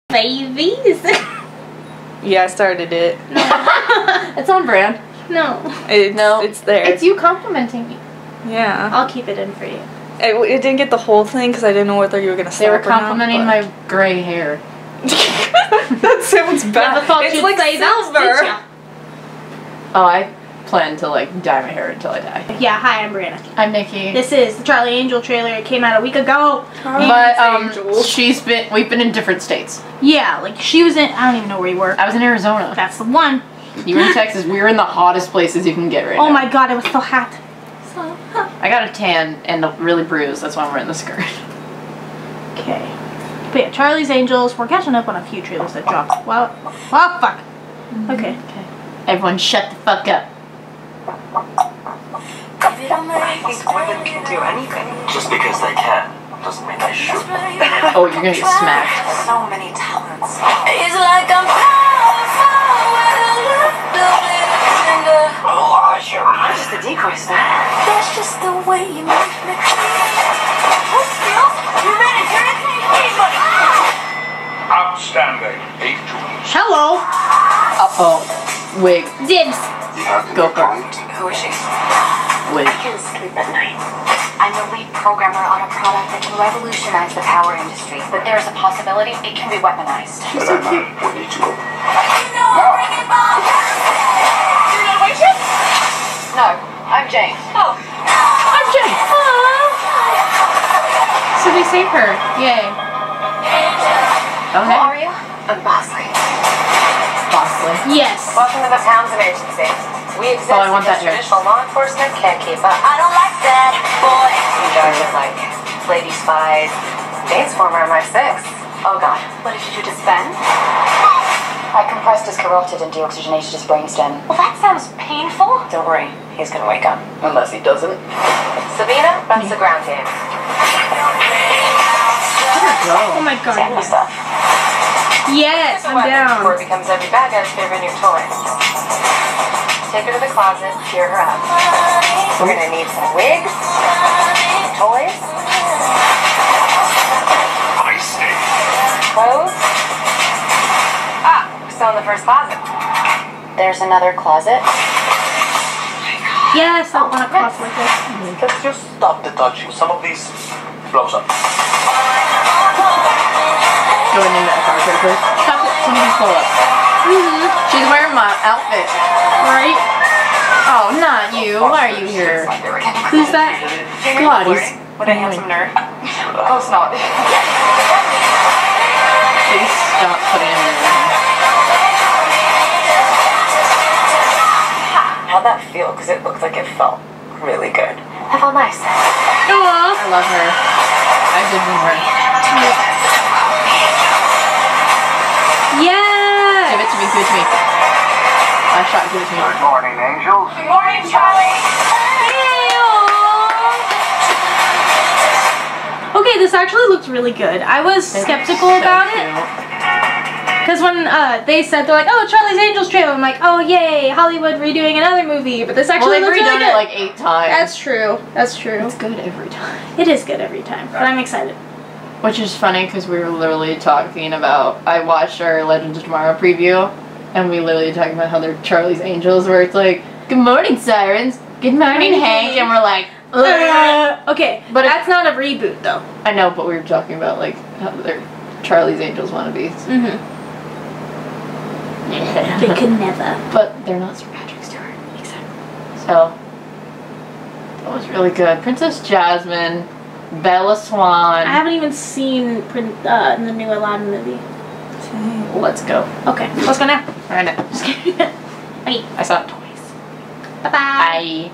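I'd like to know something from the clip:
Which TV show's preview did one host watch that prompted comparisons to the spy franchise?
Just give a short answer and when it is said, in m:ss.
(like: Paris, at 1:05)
Legends of Tomorrow, at 3:45.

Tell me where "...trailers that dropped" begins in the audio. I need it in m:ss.
0:45.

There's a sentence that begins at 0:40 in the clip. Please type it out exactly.
That's why I'm wearing the skirt.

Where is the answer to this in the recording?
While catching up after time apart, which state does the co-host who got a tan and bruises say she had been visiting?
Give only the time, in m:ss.
0:32.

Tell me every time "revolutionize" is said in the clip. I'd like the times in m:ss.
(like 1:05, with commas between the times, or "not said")
1:26.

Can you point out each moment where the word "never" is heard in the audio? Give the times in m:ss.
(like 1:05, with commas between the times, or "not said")
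0:16, 4:02.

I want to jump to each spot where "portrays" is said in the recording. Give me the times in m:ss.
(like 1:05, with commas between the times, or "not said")
not said.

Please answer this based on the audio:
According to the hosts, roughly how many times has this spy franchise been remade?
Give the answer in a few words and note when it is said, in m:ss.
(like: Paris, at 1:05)
8, at 3:36.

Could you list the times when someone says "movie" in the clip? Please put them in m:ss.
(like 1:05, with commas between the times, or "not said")
3:35, 4:14.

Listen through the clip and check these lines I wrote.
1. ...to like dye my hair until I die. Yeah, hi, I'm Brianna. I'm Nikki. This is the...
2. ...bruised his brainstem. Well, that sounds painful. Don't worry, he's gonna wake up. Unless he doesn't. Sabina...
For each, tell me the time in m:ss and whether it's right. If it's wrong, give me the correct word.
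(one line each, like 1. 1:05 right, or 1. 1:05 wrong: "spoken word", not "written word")
1. 0:20 right
2. 2:02 wrong: "deoxygenated", not "bruised".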